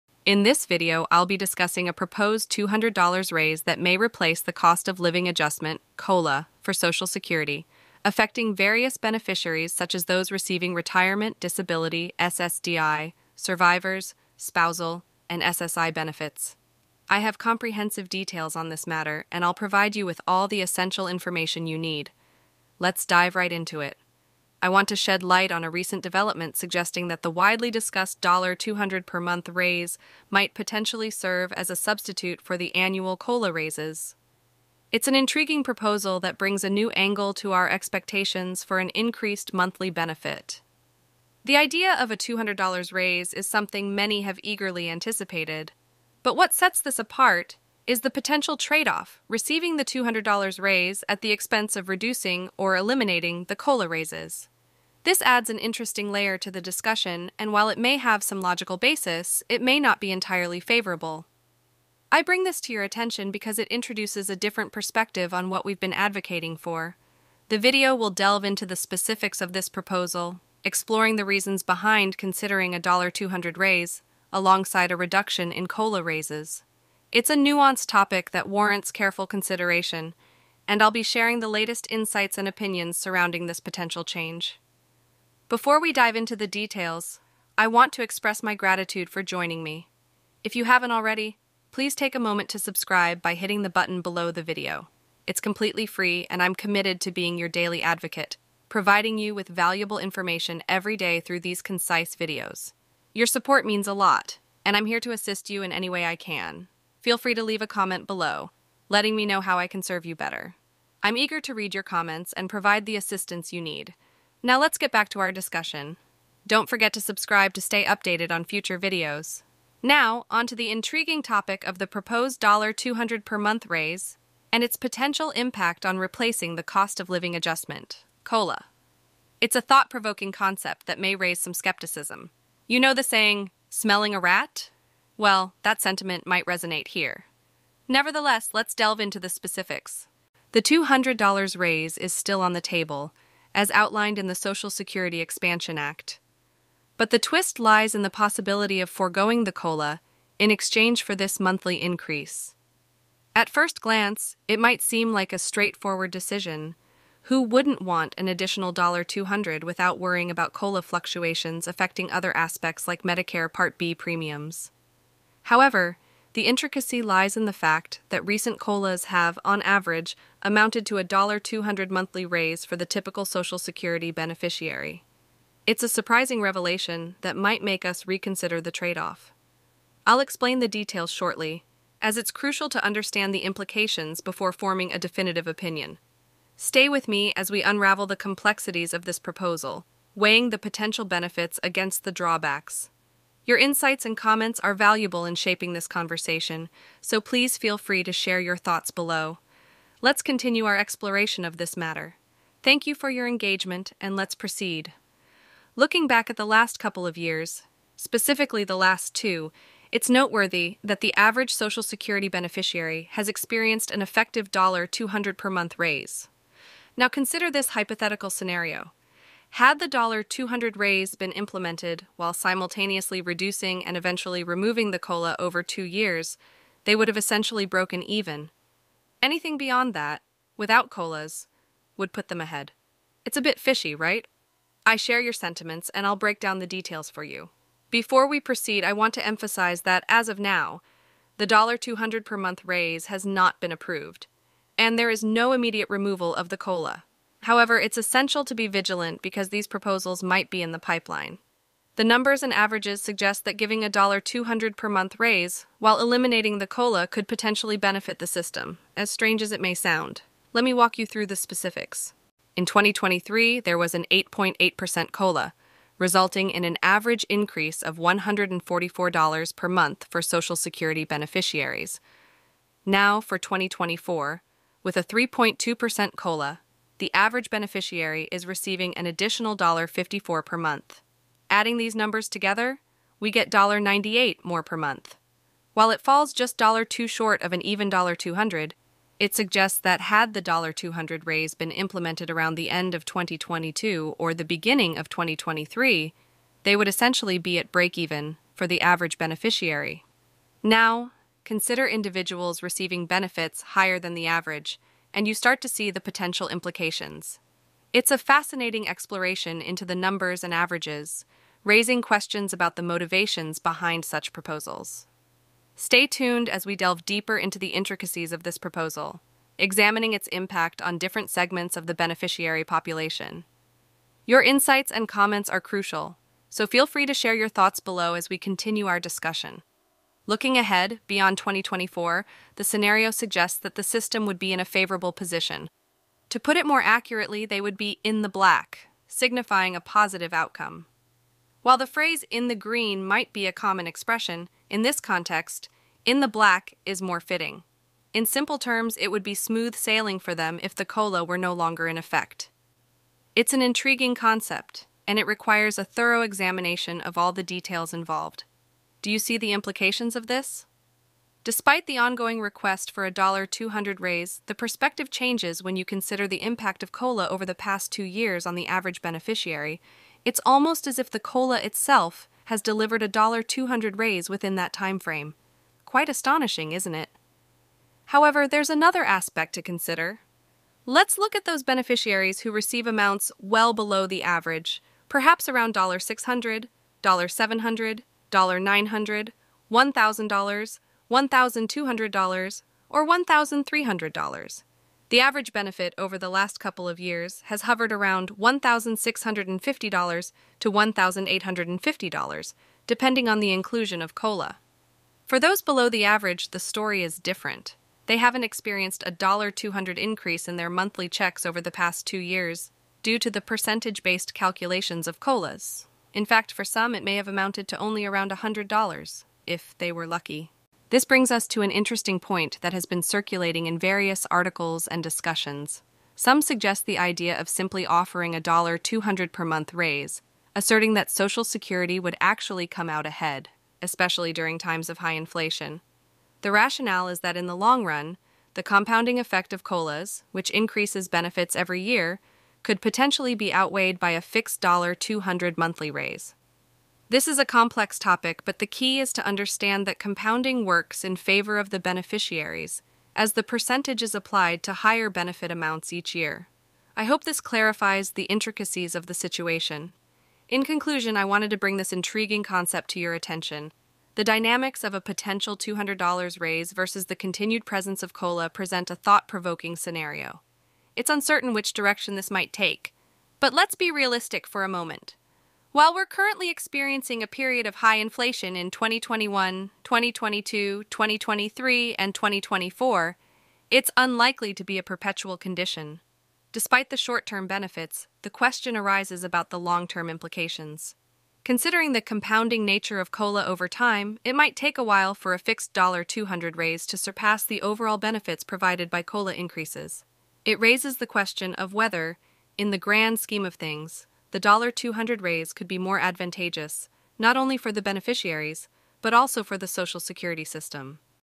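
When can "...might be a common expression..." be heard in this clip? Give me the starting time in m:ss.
5:43.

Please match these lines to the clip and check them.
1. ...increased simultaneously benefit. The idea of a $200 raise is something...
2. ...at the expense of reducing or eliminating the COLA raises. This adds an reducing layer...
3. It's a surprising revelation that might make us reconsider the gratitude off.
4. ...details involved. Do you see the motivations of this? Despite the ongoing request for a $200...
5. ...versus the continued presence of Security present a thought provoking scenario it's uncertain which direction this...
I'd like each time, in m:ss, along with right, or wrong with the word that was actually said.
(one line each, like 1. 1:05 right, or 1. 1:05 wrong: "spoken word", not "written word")
1. 0:38 wrong: "monthly", not "simultaneously"
2. 0:51 wrong: "interesting", not "reducing"
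3. 2:55 wrong: "trade", not "gratitude"
4. 5:57 wrong: "implications", not "motivations"
5. 7:46 wrong: "COLA", not "Security".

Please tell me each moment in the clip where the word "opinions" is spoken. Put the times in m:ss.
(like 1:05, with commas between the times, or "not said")
1:22, 3:05.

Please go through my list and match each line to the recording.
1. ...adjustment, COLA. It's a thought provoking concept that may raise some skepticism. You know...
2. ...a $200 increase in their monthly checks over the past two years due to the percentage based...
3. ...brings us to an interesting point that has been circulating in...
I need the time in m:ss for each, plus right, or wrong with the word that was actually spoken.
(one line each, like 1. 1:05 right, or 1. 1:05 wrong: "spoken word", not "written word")
1. 2:07 right
2. 6:49 right
3. 7:01 right.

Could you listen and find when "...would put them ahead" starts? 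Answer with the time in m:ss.
3:51.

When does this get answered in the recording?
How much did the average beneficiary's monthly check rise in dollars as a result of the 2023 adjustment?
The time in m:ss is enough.
4:27.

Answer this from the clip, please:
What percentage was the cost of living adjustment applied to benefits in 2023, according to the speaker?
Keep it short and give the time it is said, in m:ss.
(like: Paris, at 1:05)
8.8%, at 4:24.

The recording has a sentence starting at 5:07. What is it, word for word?
It's a fascinating exploration into the numbers and averages, raising questions about the motivations behind such proposals.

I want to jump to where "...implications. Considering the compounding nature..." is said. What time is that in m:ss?
8:10.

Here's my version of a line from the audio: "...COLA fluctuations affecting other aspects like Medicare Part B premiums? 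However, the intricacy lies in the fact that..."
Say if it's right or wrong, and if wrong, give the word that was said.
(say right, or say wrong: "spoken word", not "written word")
right.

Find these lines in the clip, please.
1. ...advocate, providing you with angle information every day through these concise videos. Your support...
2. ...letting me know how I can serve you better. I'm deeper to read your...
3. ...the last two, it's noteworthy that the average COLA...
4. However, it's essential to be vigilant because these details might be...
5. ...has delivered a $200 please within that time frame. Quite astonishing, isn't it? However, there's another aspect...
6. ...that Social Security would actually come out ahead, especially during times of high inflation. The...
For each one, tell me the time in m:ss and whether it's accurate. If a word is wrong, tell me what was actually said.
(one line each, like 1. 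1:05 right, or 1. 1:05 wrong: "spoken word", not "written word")
1. 1:37 wrong: "valuable", not "angle"
2. 1:48 wrong: "eager", not "deeper"
3. 3:28 wrong: "Social", not "COLA"
4. 4:07 wrong: "proposals", not "details"
5. 6:12 wrong: "raise", not "please"
6. 7:10 right.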